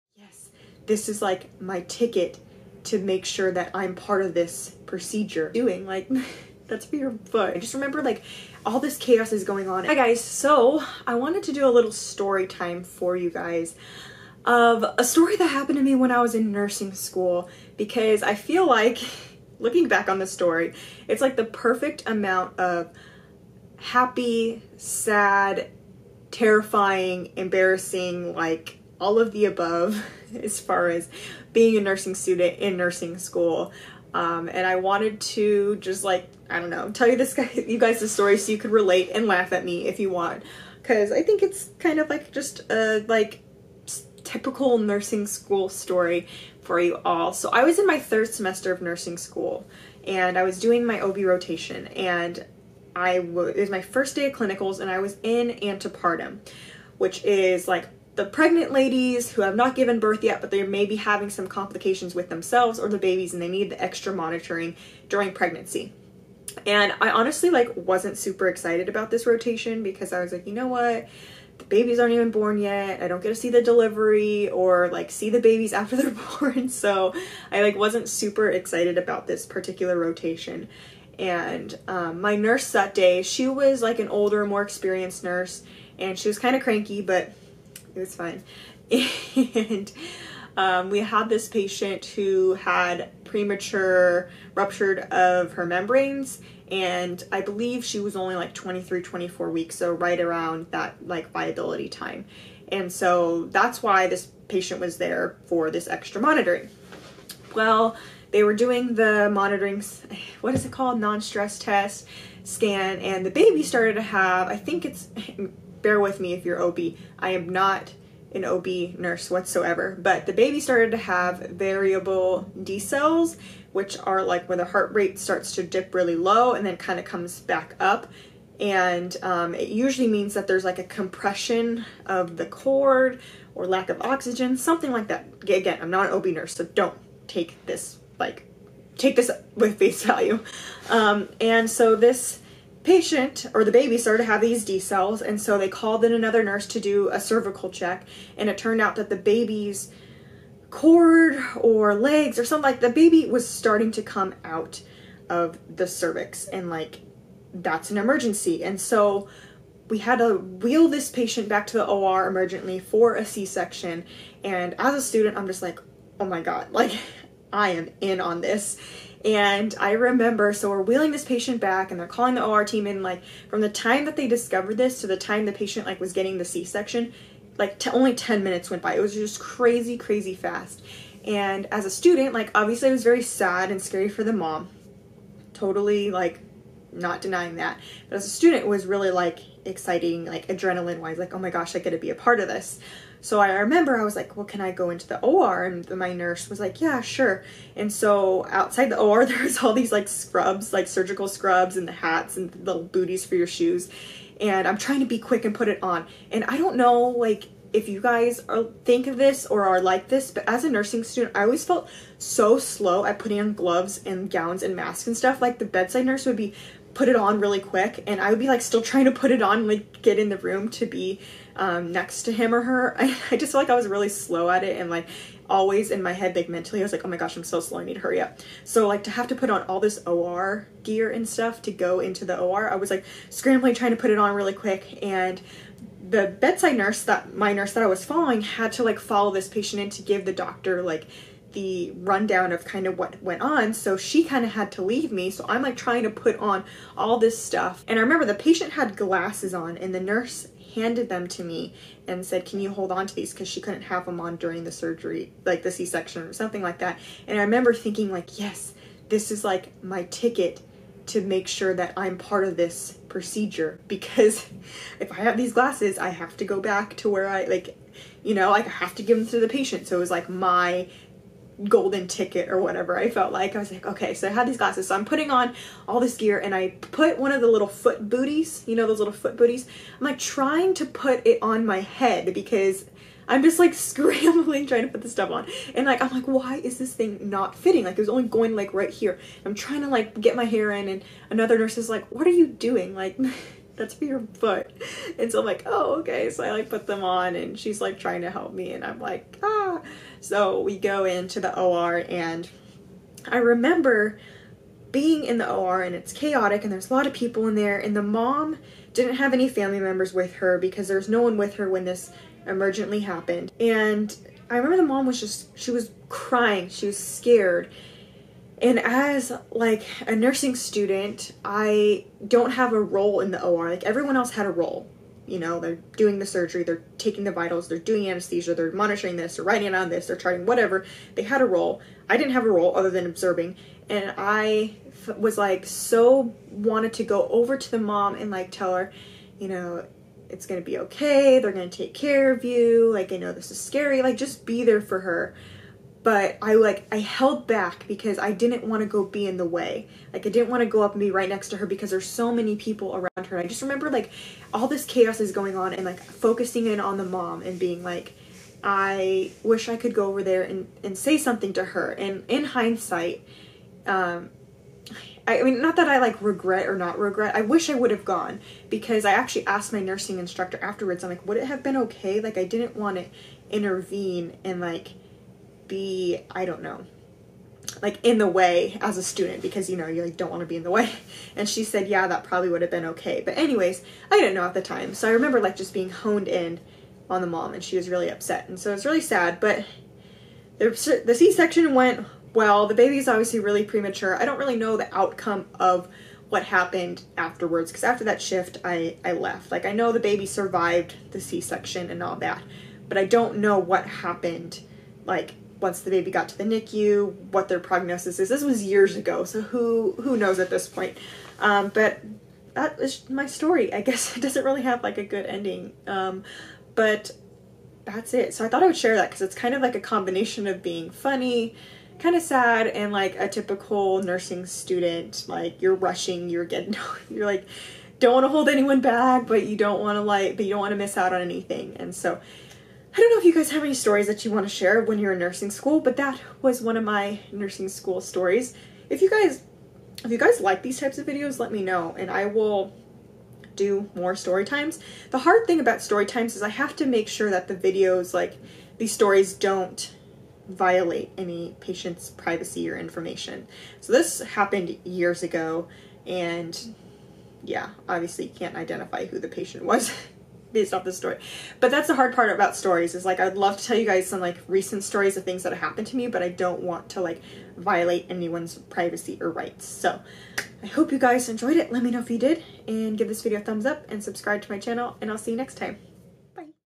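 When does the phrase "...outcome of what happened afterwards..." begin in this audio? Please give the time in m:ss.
6:34.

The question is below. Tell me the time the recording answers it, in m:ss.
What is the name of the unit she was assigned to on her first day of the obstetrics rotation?
0:55.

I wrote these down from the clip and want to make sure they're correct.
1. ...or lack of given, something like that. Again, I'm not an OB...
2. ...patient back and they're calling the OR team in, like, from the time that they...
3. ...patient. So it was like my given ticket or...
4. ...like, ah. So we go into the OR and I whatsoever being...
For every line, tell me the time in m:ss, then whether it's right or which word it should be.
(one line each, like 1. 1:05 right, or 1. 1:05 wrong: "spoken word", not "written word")
1. 2:13 wrong: "oxygen", not "given"
2. 2:51 right
3. 4:29 wrong: "golden", not "given"
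4. 4:58 wrong: "remember", not "whatsoever".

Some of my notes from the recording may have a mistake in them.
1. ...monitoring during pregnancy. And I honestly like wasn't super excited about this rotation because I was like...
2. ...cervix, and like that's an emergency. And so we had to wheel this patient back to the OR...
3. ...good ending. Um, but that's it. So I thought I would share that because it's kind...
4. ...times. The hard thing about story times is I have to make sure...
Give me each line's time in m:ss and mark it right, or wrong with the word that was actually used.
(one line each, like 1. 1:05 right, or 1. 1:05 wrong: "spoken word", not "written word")
1. 1:04 right
2. 2:35 right
3. 6:55 right
4. 7:24 right.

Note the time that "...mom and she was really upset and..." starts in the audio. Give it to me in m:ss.
6:27.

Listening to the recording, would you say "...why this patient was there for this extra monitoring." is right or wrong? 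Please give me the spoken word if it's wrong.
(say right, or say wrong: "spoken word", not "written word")
right.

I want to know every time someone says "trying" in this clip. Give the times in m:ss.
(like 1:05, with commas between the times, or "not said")
3:24, 3:38, 3:53, 4:05, 4:40, 4:44, 4:49, 4:57.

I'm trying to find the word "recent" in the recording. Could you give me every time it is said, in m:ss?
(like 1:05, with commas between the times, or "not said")
7:44.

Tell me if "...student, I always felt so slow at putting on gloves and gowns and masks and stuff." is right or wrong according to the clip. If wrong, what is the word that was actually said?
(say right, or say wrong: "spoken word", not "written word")
right.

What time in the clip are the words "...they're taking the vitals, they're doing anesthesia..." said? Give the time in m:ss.
5:26.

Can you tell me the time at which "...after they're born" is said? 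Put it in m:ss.
1:15.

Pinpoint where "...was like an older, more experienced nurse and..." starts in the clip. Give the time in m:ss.
1:23.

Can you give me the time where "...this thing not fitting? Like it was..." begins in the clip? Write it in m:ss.
4:46.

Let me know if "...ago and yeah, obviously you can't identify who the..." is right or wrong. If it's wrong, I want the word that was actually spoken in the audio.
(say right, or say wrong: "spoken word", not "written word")
right.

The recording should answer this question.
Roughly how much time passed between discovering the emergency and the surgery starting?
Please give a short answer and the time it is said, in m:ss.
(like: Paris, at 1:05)
10 minutes, at 2:58.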